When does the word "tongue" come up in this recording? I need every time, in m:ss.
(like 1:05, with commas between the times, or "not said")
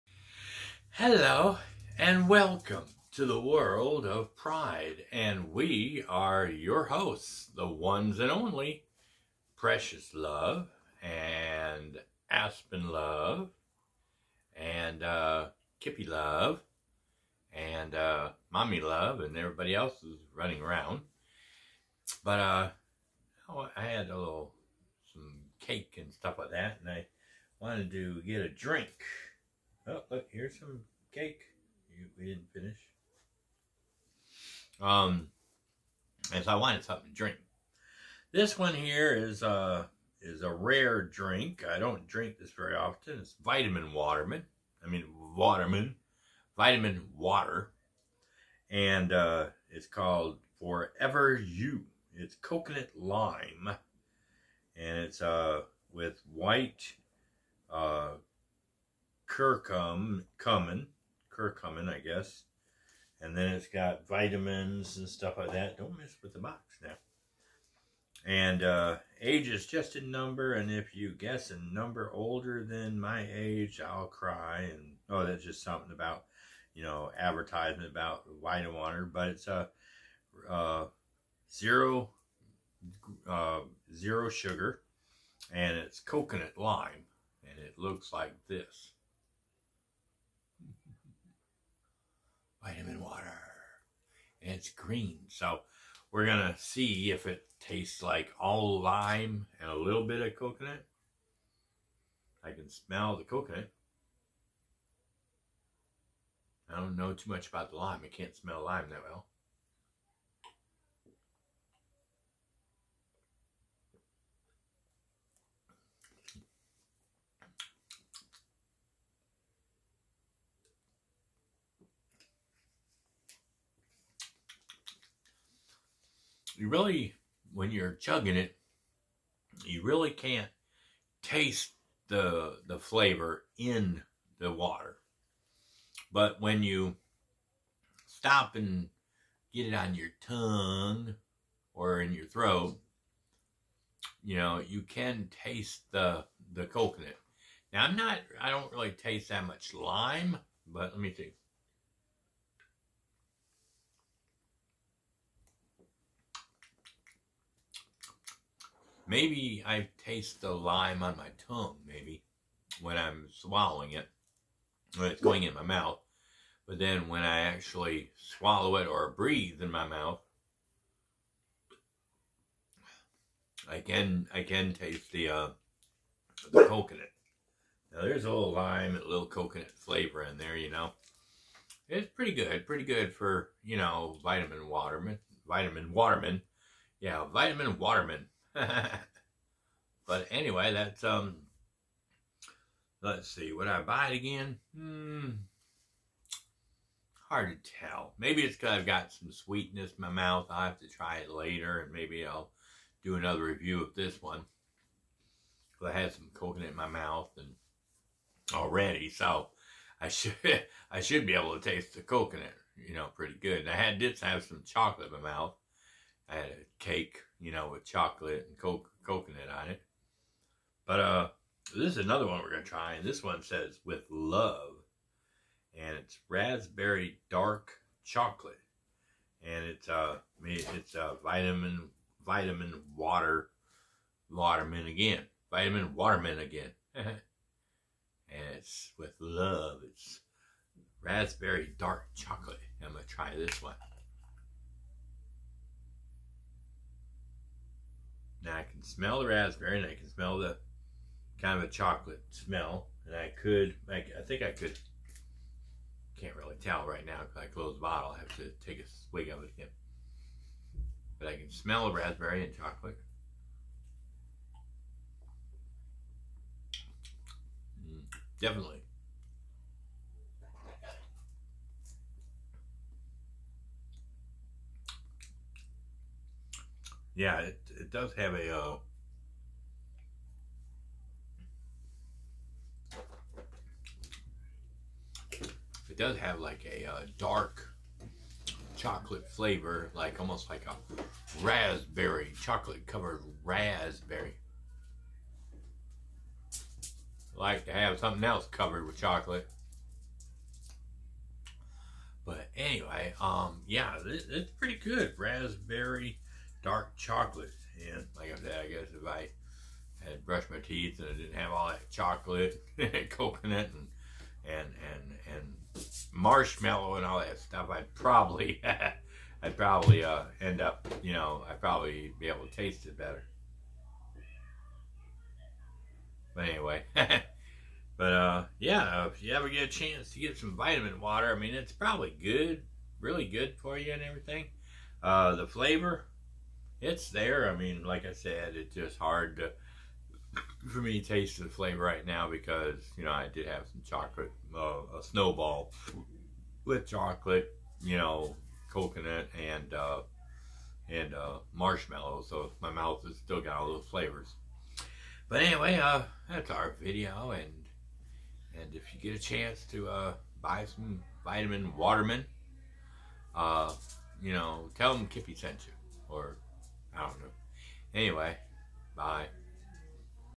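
2:20, 2:41.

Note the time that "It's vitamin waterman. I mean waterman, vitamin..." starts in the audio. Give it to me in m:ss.
0:43.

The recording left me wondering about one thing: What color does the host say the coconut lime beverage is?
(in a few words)
green.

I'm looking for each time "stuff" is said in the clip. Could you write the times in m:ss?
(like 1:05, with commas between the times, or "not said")
0:26, 1:05, 5:17.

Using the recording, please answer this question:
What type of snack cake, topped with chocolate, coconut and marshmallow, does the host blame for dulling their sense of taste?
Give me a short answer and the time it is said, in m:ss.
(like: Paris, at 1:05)
snowball, at 5:45.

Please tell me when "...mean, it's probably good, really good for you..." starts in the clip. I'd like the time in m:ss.
5:31.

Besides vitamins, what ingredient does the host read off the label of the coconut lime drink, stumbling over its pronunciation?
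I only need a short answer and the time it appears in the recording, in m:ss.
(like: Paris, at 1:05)
curcumin, at 1:01.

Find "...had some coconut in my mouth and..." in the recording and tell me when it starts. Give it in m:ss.
3:25.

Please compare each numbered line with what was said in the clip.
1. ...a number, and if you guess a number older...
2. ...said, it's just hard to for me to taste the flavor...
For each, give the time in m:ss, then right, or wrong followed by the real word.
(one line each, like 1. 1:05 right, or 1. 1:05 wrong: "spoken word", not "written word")
1. 1:09 right
2. 5:38 right.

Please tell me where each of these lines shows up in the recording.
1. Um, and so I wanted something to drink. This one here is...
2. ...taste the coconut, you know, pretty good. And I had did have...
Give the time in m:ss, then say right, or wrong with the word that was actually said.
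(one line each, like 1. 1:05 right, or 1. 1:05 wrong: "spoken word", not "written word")
1. 0:34 right
2. 3:31 right.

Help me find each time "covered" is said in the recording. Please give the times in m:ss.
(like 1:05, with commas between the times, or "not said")
4:52, 4:58.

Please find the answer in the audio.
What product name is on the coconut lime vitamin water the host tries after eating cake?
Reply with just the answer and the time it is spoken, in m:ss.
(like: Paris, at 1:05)
Forever You, at 0:50.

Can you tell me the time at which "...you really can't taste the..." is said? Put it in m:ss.
2:09.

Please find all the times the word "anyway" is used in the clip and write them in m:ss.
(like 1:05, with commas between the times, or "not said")
3:10, 5:02, 5:26, 5:55, 6:07.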